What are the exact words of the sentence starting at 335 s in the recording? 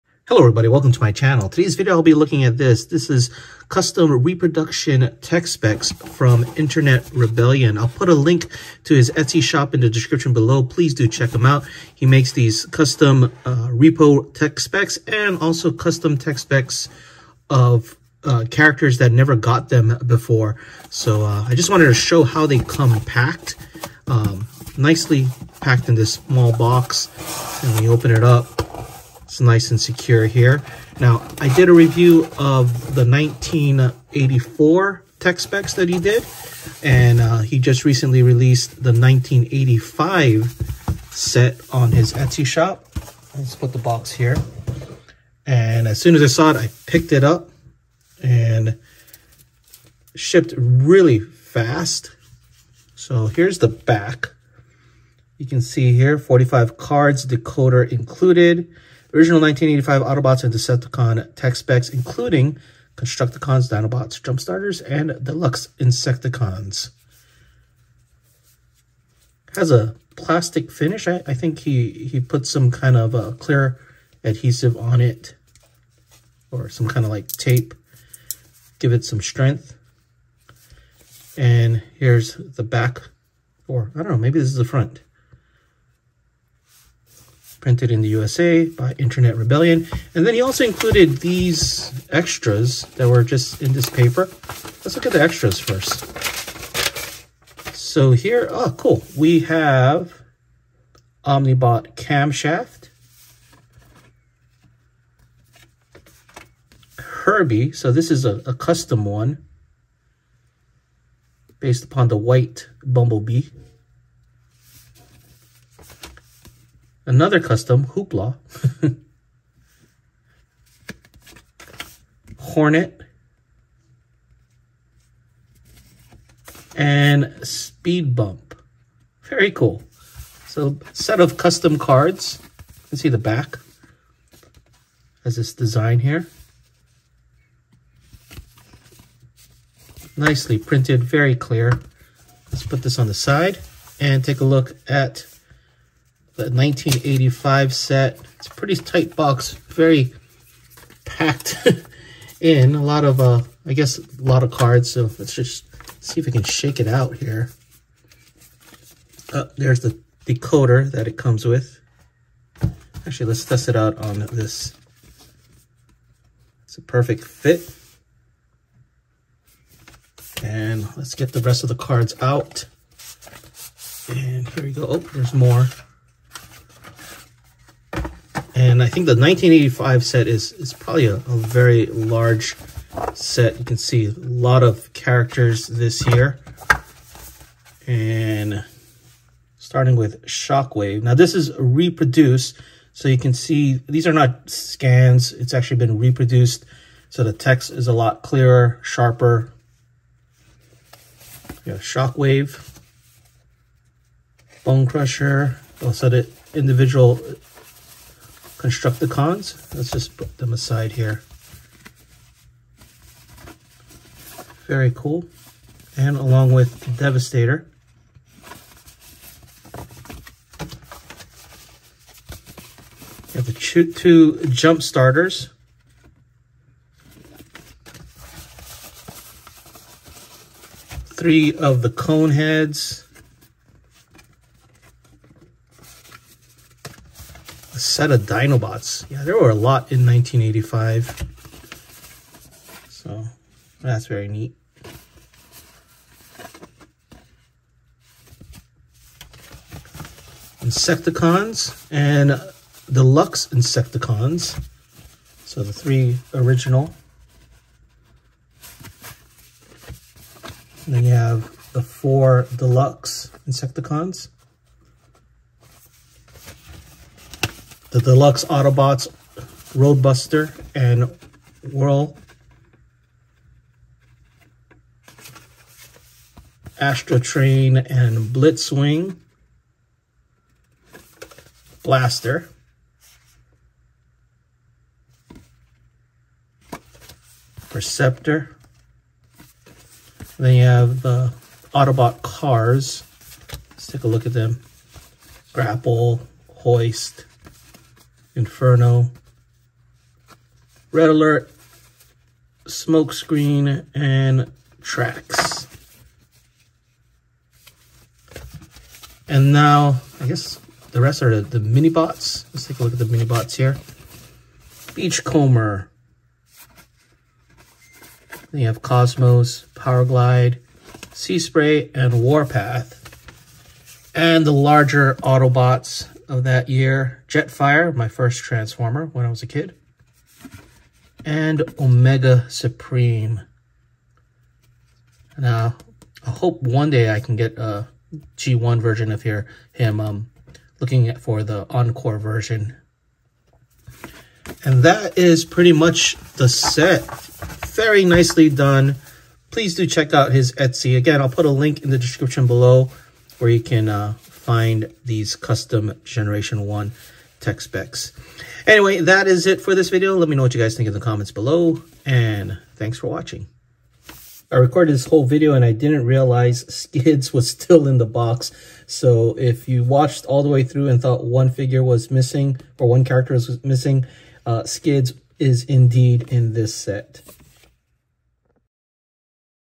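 Now, I hope one day I can get a G1 version of here, him um, looking for the Encore version.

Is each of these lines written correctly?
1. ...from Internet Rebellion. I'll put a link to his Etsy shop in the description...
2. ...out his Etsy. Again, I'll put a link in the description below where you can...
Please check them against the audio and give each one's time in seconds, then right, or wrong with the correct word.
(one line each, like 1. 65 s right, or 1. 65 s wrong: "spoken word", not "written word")
1. 5 s right
2. 350 s right.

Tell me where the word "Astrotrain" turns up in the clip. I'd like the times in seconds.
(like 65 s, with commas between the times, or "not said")
276 s.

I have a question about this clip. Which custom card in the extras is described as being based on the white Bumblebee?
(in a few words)
Herbie.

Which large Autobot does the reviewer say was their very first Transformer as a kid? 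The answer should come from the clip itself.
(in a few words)
Jetfire.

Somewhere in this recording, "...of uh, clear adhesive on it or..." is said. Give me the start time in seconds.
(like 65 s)
72 s.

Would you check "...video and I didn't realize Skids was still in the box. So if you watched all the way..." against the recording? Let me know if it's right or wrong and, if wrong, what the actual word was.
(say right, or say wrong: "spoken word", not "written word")
right.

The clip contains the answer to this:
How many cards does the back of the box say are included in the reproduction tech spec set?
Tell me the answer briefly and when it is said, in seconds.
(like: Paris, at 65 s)
45, at 56 s.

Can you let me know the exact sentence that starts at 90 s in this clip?
And then he also included these extras that were just in this paper.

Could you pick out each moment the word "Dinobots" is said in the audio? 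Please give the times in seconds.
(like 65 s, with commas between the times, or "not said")
63 s, 238 s.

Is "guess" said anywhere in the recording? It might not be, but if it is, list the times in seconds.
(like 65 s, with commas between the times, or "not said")
153 s, 310 s.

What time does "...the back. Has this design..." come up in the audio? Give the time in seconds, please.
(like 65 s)
133 s.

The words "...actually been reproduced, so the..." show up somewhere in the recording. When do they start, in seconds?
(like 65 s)
195 s.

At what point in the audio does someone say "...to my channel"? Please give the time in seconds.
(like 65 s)
0 s.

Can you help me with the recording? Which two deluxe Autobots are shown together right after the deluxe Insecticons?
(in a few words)
Roadbuster and Whirl.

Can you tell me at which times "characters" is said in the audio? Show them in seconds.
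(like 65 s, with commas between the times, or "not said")
18 s, 184 s, 373 s.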